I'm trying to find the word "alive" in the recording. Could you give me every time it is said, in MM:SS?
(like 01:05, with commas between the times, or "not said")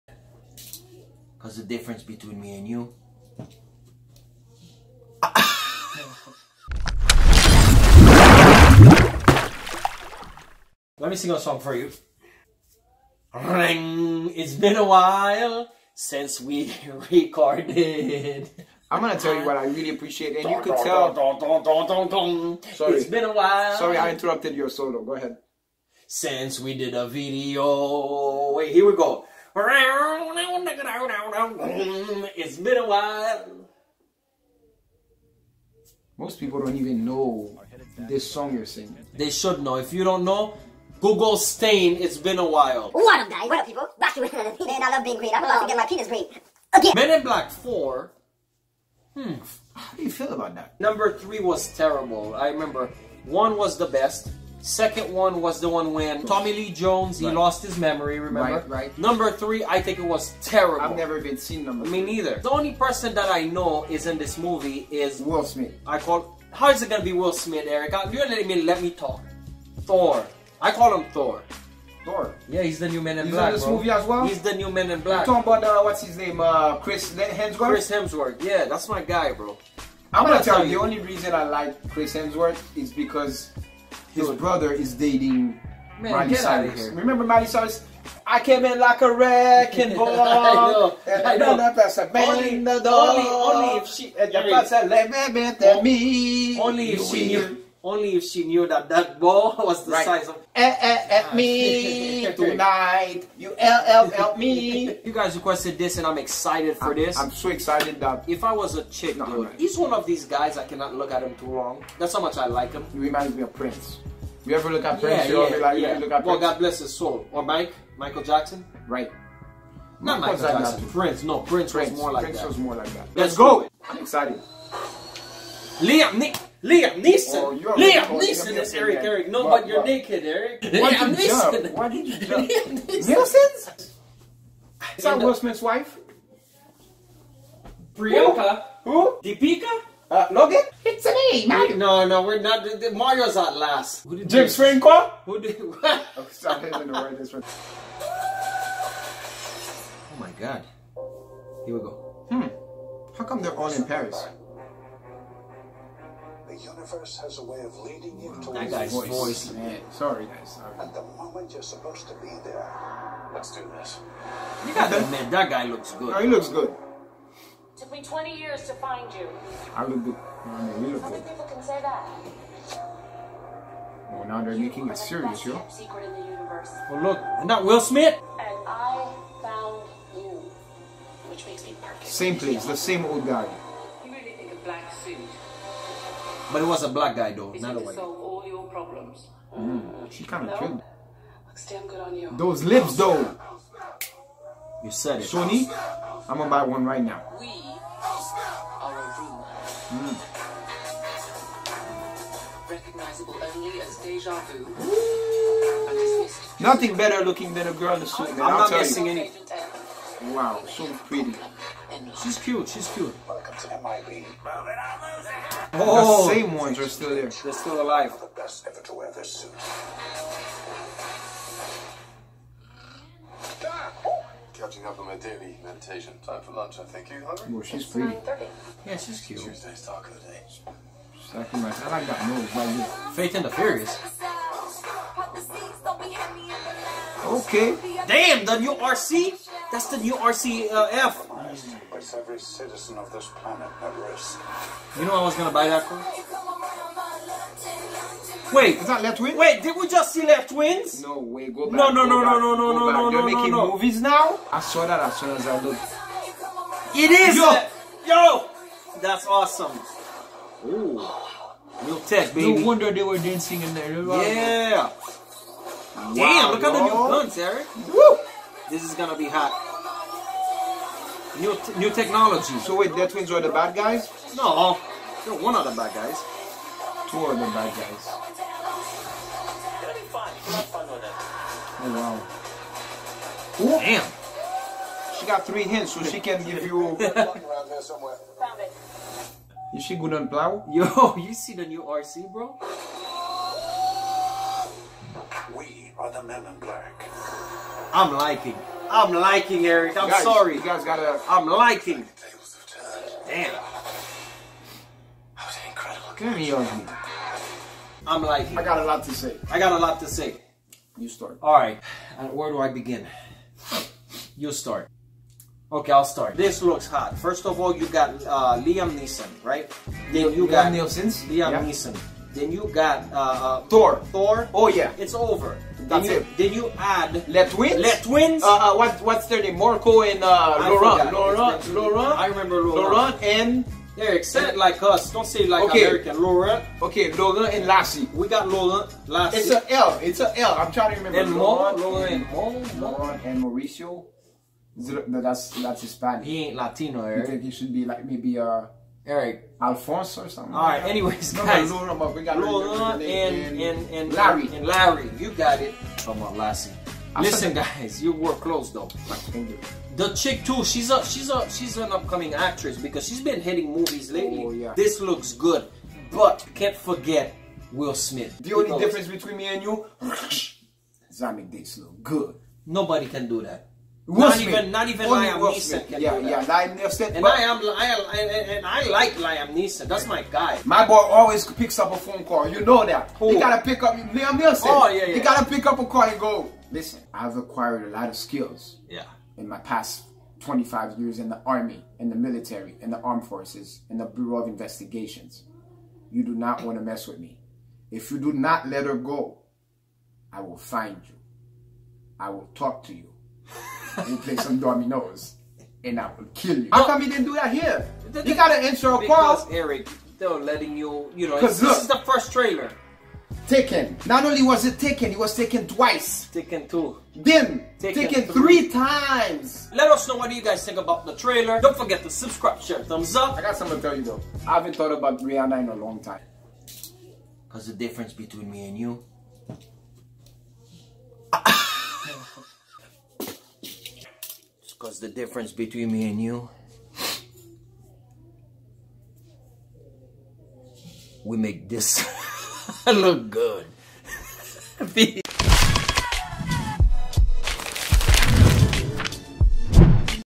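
03:37.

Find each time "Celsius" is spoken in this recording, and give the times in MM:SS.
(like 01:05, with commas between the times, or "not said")
not said.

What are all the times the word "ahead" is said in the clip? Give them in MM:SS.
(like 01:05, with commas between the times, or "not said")
00:25.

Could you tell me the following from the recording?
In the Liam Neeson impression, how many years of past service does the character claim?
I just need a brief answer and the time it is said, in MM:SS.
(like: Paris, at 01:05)
25, at 06:29.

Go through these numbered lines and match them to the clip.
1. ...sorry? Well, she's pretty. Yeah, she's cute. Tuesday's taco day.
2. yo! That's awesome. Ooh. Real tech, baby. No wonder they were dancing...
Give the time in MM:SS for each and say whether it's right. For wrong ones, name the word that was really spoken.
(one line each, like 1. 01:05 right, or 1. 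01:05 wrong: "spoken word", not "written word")
1. 03:47 wrong: "hungry", not "sorry"
2. 04:18 right.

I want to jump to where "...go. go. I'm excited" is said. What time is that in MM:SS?
02:03.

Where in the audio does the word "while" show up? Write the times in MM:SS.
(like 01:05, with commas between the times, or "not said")
00:14, 00:23, 00:32, 00:42.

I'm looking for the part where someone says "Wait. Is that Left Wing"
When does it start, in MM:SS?
04:08.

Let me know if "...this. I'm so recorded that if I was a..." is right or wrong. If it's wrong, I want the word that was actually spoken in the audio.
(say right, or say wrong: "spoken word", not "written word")
wrong: "excited", not "recorded".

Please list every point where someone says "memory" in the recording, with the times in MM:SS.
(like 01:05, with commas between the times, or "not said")
00:57.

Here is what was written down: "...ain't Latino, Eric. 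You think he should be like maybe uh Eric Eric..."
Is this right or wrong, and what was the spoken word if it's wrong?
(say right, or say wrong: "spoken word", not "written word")
wrong: "Alfonso", not "Eric".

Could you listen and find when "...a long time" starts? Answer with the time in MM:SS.
07:05.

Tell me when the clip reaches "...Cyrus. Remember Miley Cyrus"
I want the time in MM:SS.
01:26.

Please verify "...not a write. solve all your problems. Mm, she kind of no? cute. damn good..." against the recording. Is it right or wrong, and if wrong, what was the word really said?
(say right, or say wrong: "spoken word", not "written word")
wrong: "white", not "write".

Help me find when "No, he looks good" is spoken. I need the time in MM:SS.
02:46.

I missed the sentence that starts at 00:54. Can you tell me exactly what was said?
Second one was the one when Tommy Lee Jones, he right.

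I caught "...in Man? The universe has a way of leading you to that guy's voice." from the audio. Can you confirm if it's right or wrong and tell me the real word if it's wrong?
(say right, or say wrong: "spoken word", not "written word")
wrong: "Paris", not "Man".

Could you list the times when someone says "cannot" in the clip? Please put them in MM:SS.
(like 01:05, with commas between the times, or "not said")
01:50.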